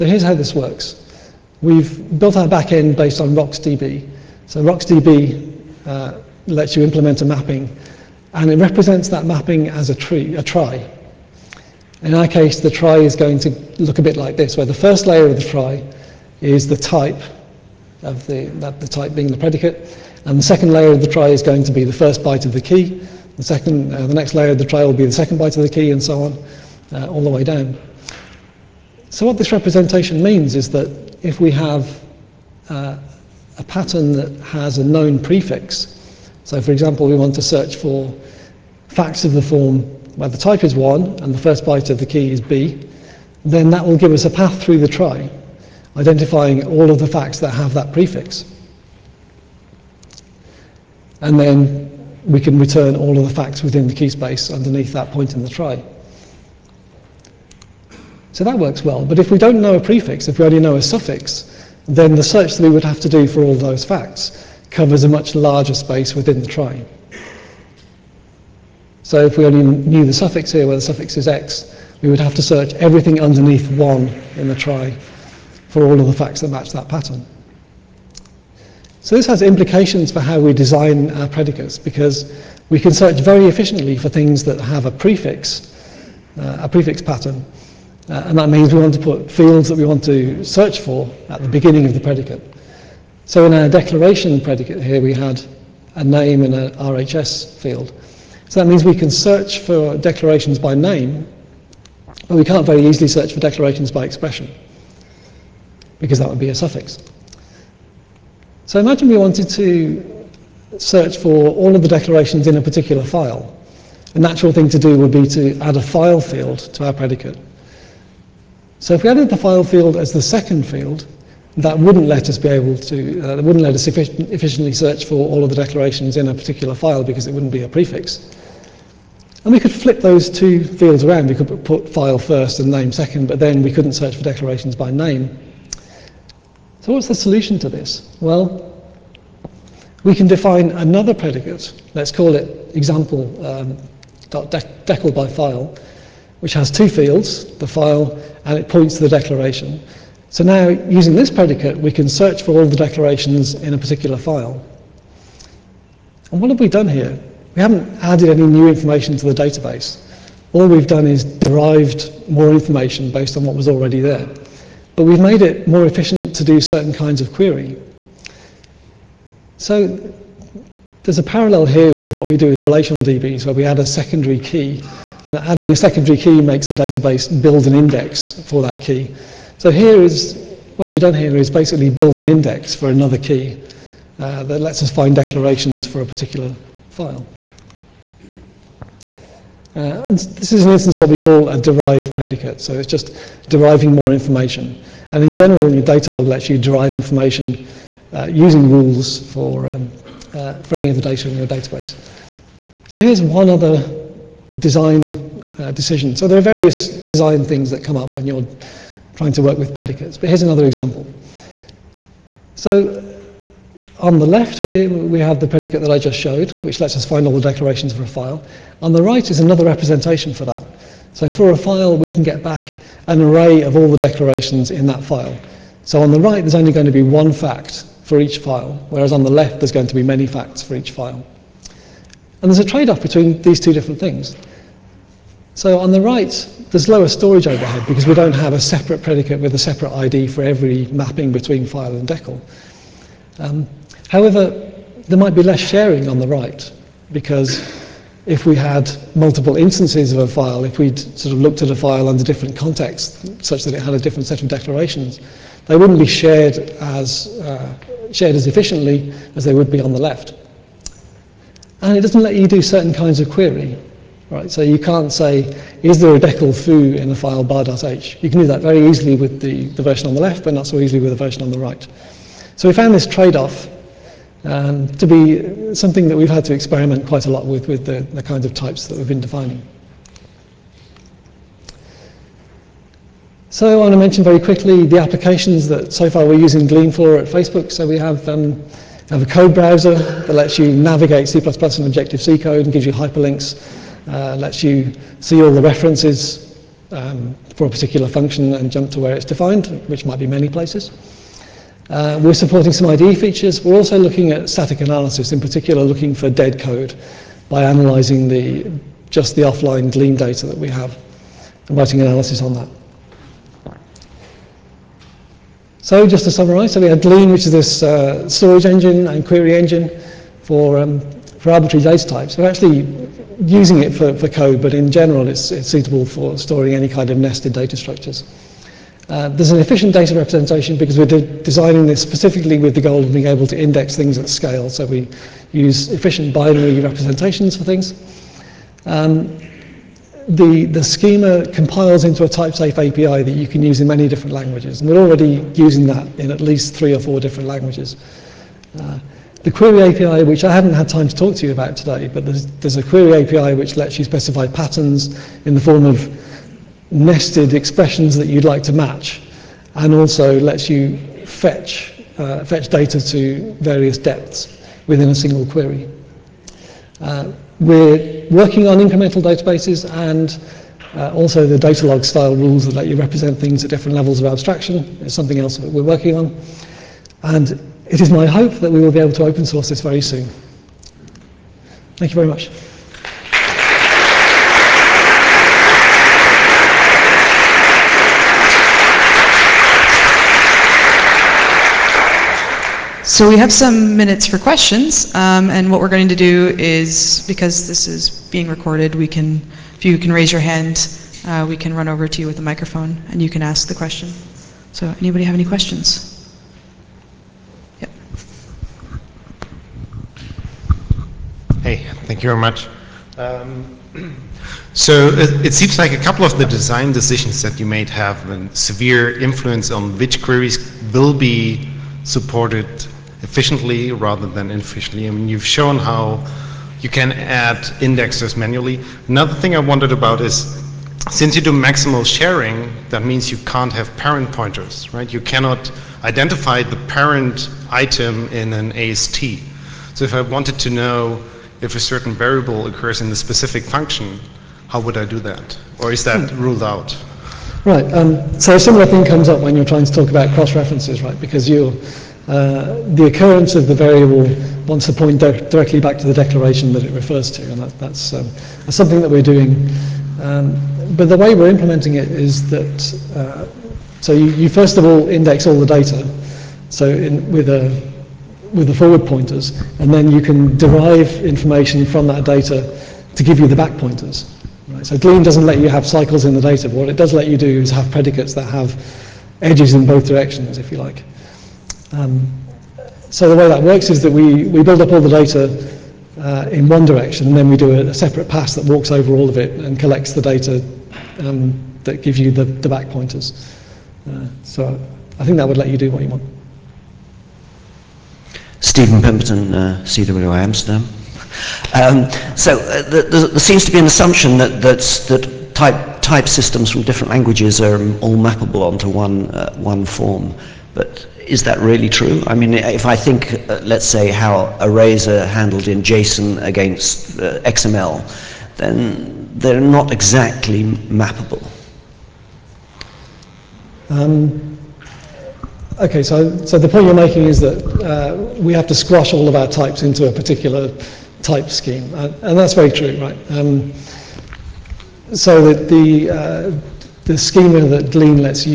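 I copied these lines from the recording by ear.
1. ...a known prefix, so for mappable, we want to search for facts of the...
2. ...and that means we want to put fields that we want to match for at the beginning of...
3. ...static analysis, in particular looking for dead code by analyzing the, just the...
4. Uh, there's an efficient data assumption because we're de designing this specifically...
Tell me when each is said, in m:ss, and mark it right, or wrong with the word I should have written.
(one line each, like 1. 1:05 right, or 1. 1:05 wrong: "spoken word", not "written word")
1. 0:34 wrong: "example", not "mappable"
2. 1:28 wrong: "search", not "match"
3. 5:04 right
4. 5:29 wrong: "representation", not "assumption".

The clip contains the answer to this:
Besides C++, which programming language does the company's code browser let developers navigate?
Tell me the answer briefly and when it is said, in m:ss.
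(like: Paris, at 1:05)
Objective-C, at 4:51.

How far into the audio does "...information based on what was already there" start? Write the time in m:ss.
2:42.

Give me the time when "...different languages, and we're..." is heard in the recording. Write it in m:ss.
5:44.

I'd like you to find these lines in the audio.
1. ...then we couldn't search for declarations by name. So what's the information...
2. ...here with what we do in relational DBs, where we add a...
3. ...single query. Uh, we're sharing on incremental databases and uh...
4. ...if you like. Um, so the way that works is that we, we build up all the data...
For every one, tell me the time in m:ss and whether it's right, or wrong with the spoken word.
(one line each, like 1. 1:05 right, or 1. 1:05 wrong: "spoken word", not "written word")
1. 2:13 wrong: "solution", not "information"
2. 2:51 right
3. 6:05 wrong: "working", not "sharing"
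4. 8:00 right.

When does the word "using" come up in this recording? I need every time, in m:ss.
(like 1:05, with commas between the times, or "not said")
2:30, 3:18, 4:46, 5:23, 5:45.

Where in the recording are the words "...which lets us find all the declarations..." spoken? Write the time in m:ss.
3:36.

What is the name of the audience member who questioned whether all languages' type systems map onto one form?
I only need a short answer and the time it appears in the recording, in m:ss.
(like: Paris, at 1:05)
Steven Pemberton, at 8:18.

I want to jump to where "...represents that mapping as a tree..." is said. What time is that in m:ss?
0:08.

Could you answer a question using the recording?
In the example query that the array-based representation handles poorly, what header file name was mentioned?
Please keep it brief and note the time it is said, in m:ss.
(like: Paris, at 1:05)
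bar.h, at 4:27.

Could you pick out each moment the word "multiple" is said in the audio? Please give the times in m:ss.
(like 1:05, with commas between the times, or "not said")
4:09.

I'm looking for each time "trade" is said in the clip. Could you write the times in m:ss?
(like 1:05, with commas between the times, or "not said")
3:52, 4:33.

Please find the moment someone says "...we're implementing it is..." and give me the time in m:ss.
7:41.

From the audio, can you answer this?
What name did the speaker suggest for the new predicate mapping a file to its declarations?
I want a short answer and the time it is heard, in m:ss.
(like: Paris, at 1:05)
by file, at 2:25.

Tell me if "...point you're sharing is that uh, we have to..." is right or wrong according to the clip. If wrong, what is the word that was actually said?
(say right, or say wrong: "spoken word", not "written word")
wrong: "making", not "sharing".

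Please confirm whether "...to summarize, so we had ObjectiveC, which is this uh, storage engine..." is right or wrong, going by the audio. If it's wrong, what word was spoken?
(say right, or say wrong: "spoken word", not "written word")
wrong: "Glean", not "ObjectiveC".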